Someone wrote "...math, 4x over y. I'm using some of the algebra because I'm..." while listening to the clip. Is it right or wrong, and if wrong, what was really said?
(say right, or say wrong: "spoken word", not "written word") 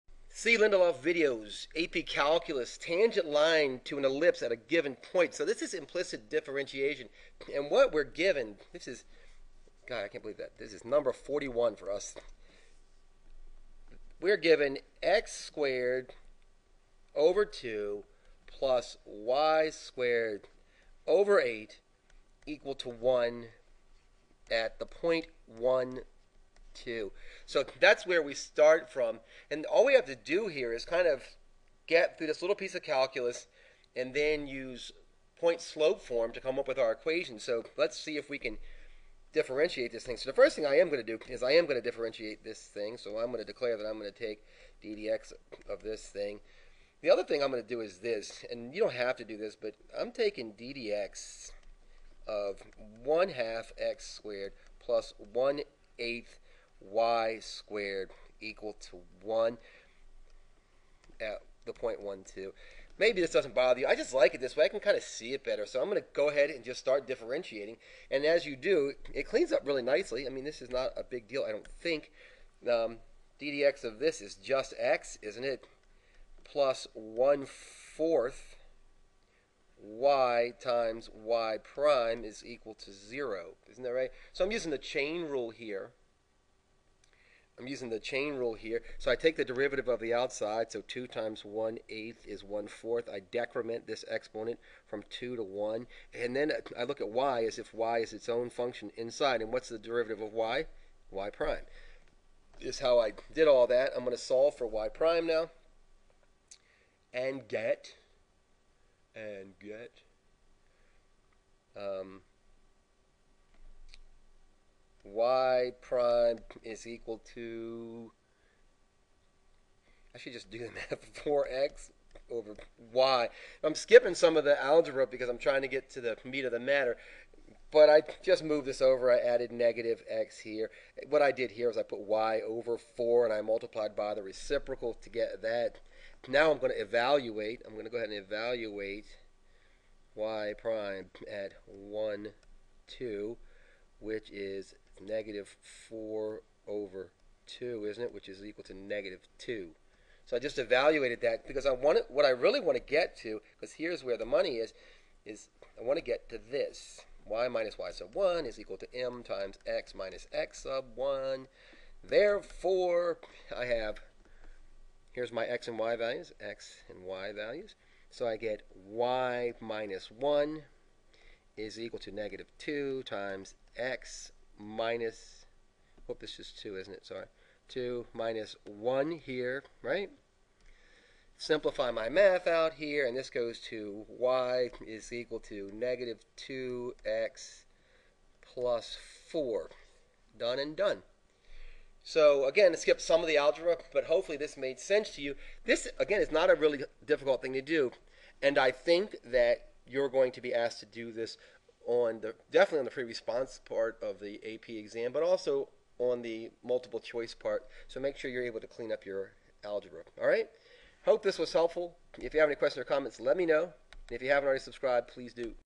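wrong: "skipping", not "using".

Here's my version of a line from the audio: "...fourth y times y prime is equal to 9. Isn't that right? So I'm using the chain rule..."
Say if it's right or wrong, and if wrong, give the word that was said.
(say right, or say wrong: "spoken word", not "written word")
wrong: "0", not "9".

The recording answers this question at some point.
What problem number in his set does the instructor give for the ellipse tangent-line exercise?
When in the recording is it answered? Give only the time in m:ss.
0:10.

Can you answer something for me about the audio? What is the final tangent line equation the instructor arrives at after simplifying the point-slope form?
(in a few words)
y = -2x + 4.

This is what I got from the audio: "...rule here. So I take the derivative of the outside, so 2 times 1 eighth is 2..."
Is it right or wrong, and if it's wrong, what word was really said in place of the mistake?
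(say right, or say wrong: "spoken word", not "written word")
wrong: "1", not "2".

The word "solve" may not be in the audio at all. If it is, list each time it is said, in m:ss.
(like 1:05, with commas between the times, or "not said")
1:44.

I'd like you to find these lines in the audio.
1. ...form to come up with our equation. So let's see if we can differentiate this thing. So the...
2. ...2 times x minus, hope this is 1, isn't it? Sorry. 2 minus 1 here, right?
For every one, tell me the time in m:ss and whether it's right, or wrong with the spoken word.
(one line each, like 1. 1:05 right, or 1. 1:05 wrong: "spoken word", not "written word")
1. 0:36 right
2. 2:52 wrong: "2", not "1".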